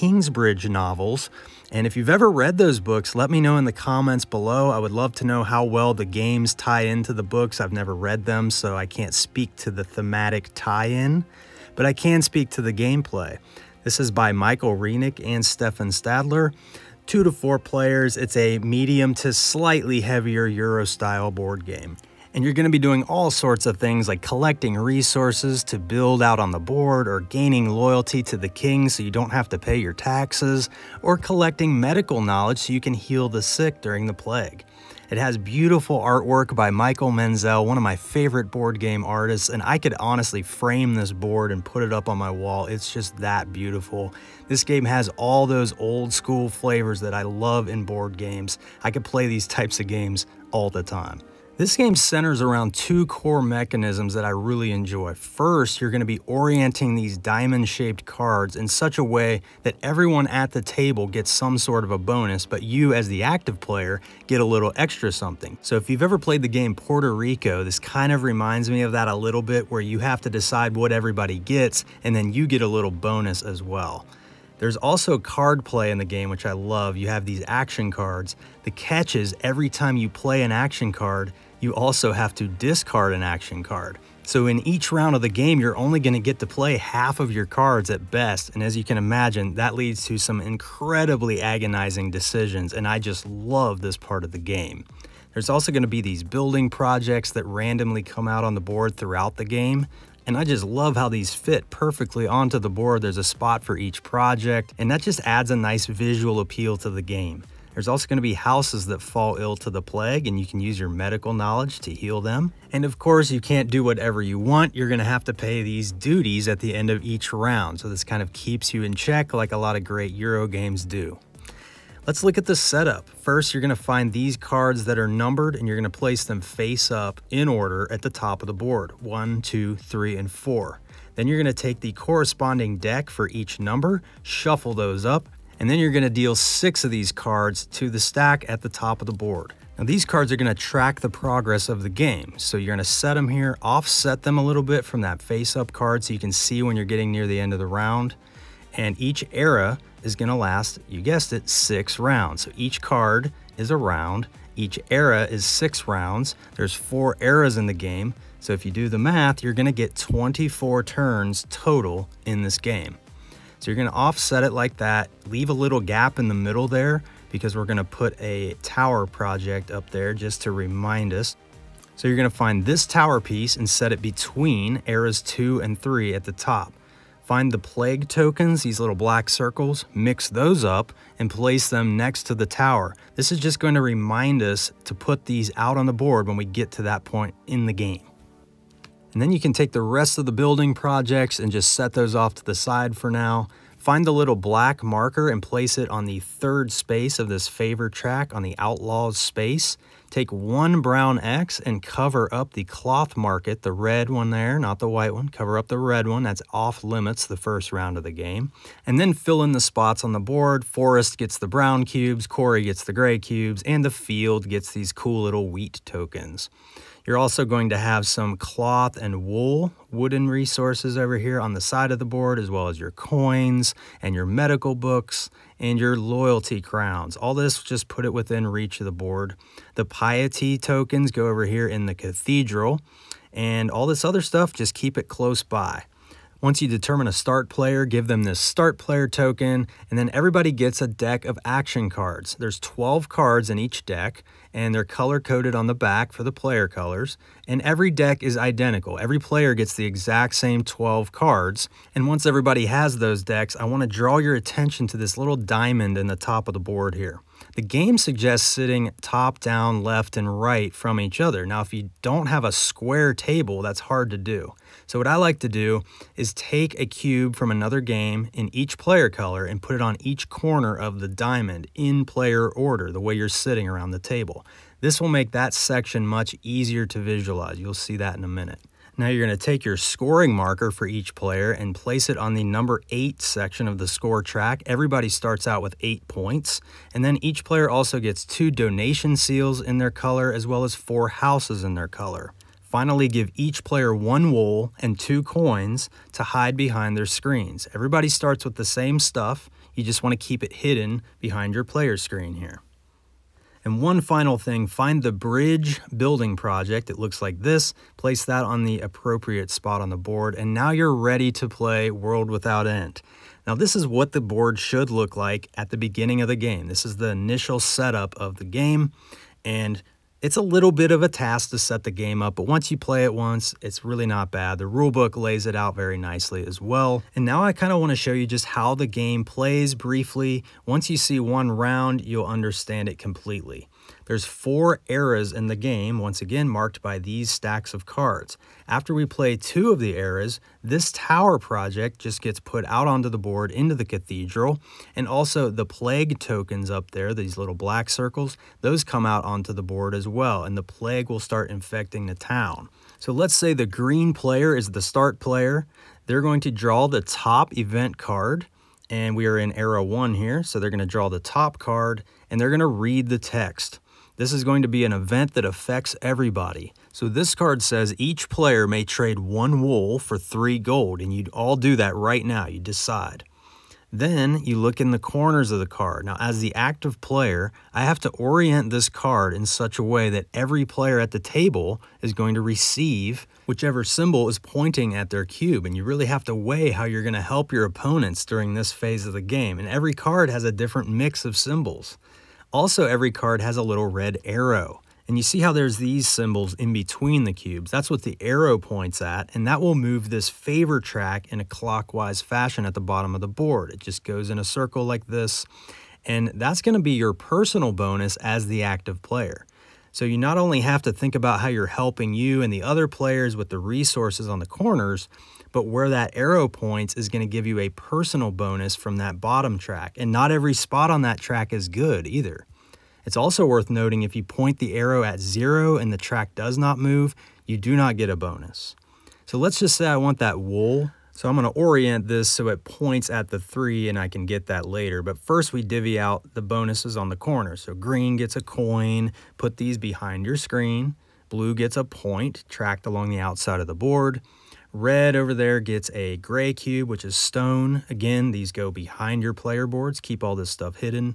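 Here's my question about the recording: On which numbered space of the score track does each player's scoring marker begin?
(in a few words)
8.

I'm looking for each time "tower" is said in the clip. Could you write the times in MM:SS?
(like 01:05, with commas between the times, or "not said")
02:48, 02:52, 03:02, 05:40.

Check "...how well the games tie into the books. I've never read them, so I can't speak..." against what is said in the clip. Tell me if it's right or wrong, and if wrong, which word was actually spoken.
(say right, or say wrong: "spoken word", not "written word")
right.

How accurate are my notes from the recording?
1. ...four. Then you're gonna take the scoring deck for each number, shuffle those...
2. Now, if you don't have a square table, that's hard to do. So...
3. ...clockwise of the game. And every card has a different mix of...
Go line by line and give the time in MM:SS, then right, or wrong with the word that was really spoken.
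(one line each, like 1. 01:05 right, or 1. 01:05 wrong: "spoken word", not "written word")
1. 02:10 wrong: "corresponding", not "scoring"
2. 04:21 right
3. 06:28 wrong: "phase", not "clockwise".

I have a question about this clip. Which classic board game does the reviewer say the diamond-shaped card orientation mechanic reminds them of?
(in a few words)
Puerto Rico.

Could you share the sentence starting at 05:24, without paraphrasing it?
The rulebook lays it out very nicely as well.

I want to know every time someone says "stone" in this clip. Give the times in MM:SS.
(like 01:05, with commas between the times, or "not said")
07:27.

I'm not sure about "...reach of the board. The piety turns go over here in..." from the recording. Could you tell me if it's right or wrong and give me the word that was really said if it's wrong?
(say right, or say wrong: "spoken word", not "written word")
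wrong: "tokens", not "turns".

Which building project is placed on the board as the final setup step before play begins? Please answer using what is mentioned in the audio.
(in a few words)
bridge.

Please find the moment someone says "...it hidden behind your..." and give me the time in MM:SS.
05:00.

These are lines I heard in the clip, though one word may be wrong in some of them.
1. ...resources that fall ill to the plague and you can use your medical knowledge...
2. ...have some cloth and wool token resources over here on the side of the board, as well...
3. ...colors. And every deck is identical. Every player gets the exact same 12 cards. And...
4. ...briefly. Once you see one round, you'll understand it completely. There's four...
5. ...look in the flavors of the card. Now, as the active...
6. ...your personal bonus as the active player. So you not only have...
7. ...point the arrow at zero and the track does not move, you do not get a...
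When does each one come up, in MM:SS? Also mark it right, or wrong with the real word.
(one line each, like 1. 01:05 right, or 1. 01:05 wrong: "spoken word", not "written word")
1. 01:48 wrong: "houses", not "resources"
2. 03:37 wrong: "wooden", not "token"
3. 04:06 right
4. 05:29 right
5. 06:14 wrong: "corners", not "flavors"
6. 06:46 right
7. 07:04 right.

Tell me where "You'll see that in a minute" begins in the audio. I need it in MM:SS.
04:37.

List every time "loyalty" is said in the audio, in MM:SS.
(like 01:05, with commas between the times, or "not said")
00:27, 03:45.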